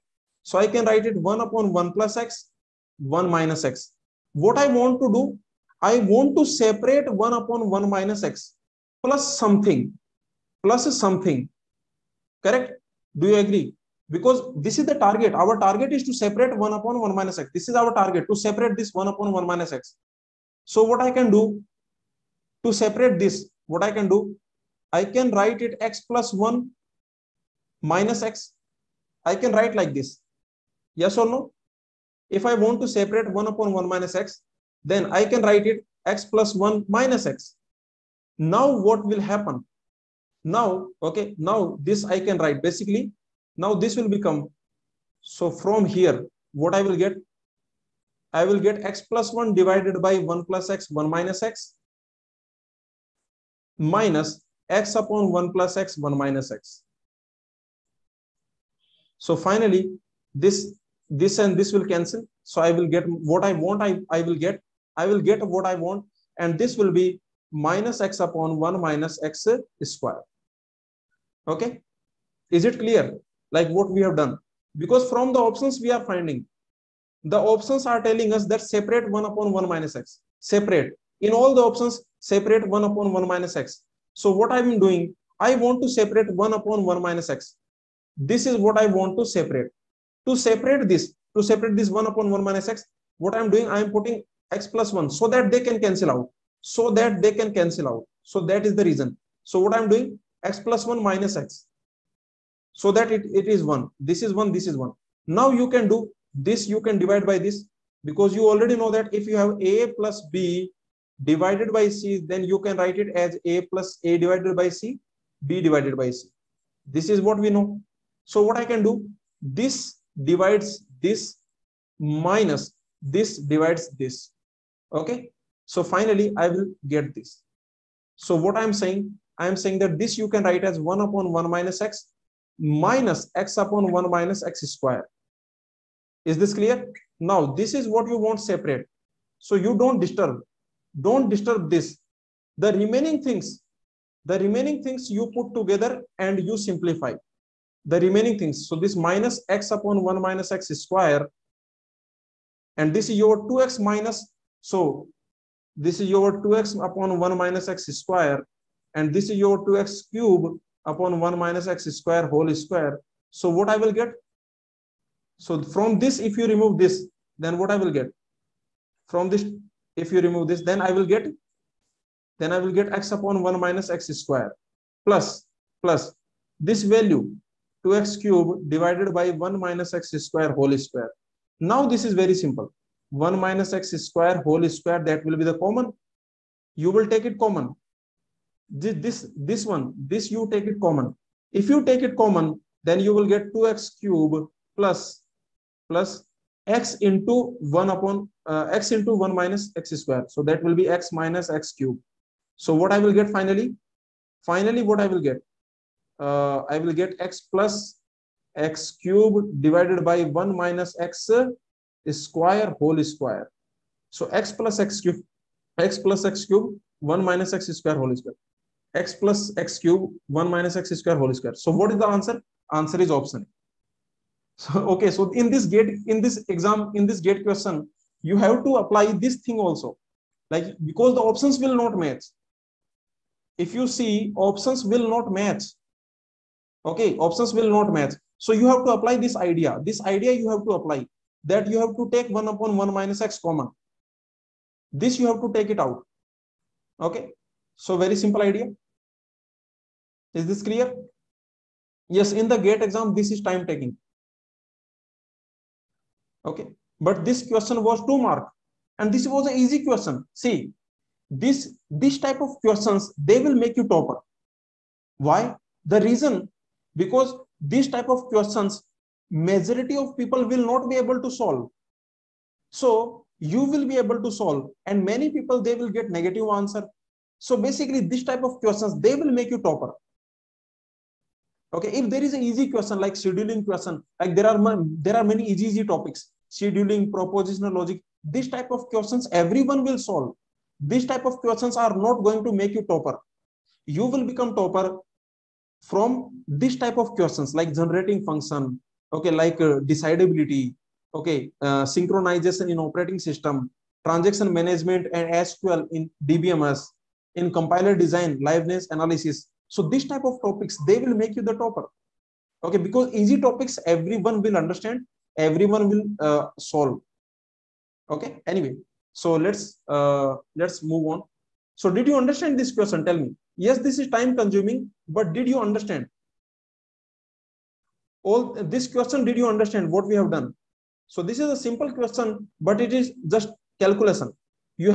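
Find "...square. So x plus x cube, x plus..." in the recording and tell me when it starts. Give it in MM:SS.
03:33.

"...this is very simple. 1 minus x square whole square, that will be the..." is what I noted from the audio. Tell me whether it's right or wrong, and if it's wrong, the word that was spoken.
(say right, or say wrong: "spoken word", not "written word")
right.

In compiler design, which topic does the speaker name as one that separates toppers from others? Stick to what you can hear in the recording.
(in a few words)
liveness analysis.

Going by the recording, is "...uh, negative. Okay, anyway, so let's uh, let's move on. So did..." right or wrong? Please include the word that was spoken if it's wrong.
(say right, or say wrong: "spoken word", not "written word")
wrong: "solve", not "negative".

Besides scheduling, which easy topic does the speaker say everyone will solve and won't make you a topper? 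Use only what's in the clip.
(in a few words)
propositional logic.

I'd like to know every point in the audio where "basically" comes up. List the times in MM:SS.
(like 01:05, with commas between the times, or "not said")
00:42, 04:37.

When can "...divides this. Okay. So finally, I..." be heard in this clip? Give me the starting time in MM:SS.
02:03.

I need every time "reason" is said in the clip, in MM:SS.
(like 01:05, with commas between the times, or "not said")
01:38, 04:26.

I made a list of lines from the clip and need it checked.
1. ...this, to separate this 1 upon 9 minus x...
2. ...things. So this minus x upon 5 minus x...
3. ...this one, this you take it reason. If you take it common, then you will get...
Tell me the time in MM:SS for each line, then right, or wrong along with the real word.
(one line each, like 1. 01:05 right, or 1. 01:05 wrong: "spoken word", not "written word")
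1. 01:30 wrong: "1", not "9"
2. 02:28 wrong: "1", not "5"
3. 03:09 wrong: "common", not "reason".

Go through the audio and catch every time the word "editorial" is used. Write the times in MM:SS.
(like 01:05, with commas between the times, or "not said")
not said.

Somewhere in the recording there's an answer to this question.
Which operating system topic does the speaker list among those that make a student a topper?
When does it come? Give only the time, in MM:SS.
05:01.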